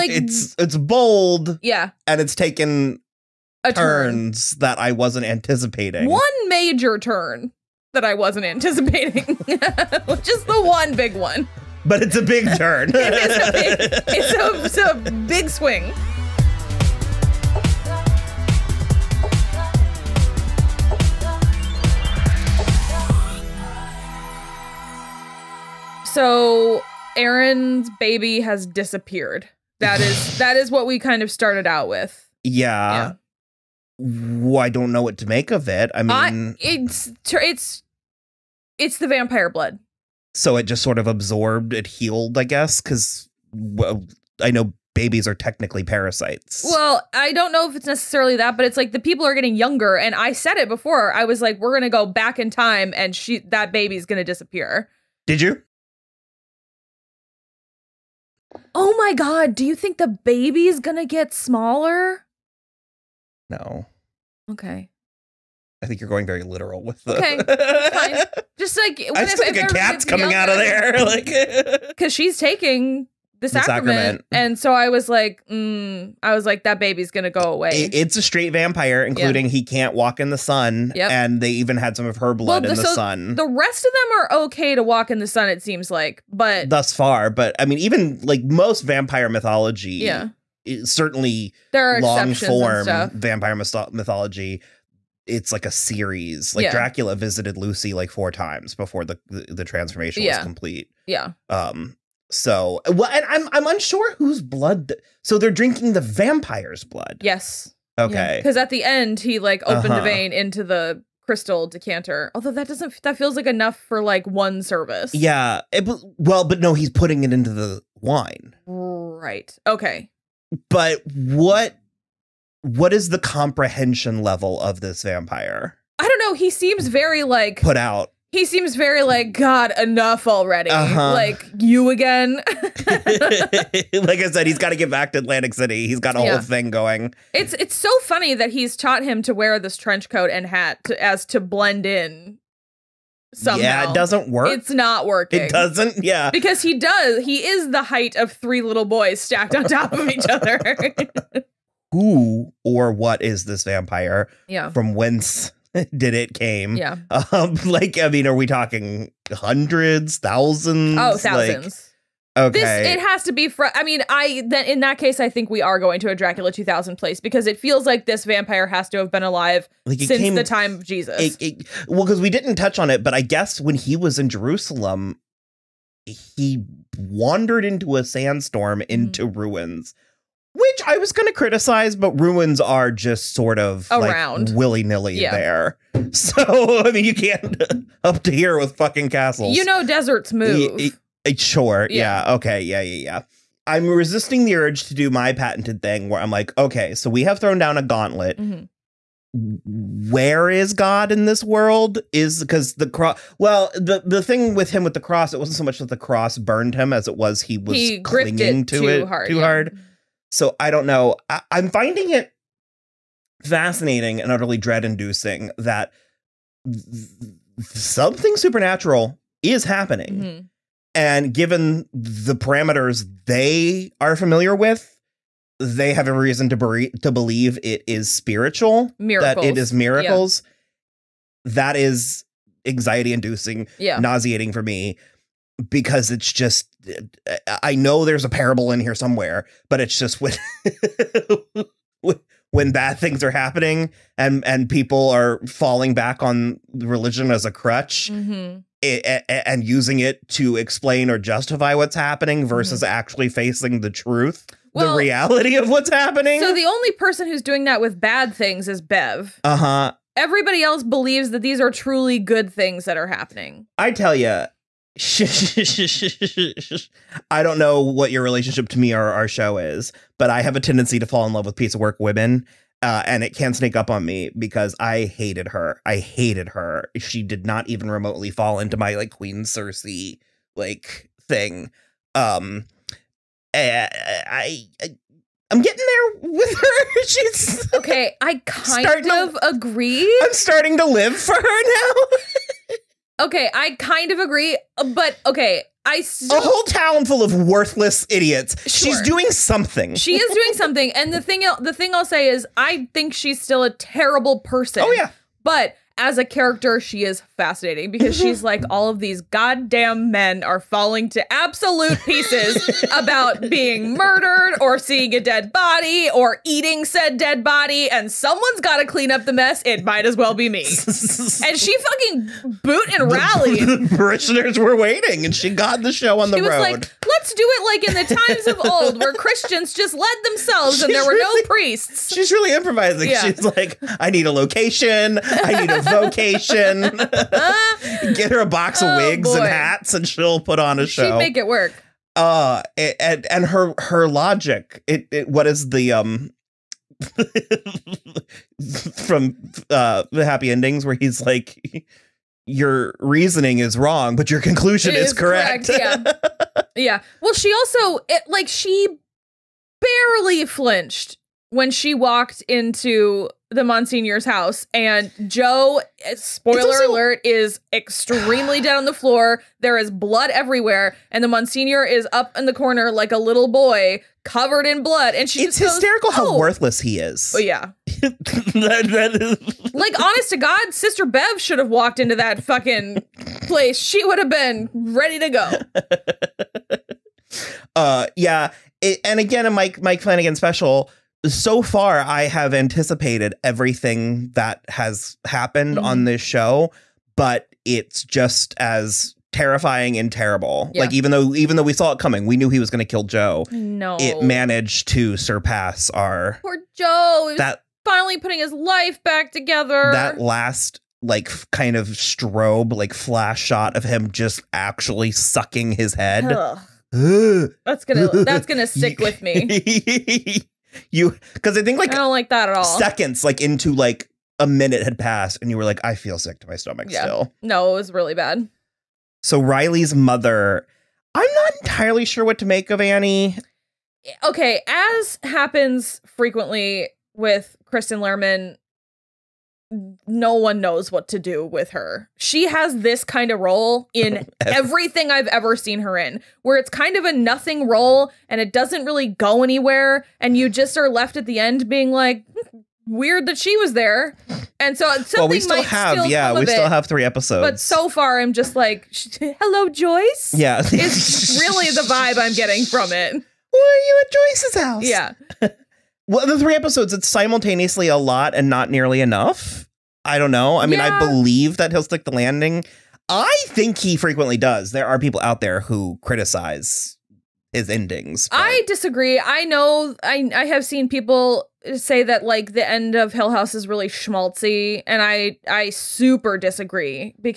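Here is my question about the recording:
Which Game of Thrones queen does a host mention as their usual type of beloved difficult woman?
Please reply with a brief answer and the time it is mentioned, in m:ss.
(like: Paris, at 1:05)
Queen Cersei, at 4:39.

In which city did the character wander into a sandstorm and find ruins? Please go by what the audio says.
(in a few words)
Jerusalem.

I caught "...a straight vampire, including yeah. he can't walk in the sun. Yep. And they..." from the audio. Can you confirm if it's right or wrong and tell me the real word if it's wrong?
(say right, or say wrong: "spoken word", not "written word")
right.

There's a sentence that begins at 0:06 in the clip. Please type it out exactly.
One major turn that I wasn't anticipating.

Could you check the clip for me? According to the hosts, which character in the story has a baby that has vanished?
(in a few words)
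Erin.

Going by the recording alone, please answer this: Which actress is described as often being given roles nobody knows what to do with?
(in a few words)
Kristin Lehman.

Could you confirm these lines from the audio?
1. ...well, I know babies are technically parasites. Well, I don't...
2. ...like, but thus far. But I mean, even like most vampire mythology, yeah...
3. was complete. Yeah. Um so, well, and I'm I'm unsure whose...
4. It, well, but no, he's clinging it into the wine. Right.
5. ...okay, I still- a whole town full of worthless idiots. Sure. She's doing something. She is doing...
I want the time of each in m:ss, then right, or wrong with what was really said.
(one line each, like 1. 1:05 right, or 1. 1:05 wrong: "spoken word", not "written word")
1. 0:43 right
2. 1:25 right
3. 1:40 right
4. 1:55 wrong: "putting", not "clinging"
5. 4:55 right.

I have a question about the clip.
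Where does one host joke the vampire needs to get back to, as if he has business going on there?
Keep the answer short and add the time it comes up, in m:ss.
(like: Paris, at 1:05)
Atlantic City, at 2:15.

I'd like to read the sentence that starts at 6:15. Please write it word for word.
And she it's hysterical goes, how oh.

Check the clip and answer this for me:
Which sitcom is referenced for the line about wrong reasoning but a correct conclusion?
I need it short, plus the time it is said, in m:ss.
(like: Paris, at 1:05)
Happy Endings, at 5:50.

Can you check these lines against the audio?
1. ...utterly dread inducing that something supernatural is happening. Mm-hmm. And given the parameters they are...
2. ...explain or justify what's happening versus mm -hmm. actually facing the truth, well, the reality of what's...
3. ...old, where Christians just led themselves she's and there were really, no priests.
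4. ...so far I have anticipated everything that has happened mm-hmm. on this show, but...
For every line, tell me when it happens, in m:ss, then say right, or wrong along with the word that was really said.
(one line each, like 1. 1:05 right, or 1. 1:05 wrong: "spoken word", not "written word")
1. 3:34 right
2. 4:10 right
3. 5:28 right
4. 6:31 right.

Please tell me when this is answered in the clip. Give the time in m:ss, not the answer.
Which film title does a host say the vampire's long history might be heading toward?
2:46.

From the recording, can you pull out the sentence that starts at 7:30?
And you just are left at the end being like, weird that she was there.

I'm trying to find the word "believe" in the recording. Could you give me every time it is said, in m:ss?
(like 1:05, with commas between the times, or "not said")
3:47, 4:20, 7:50.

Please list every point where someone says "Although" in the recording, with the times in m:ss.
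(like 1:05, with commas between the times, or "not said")
1:52.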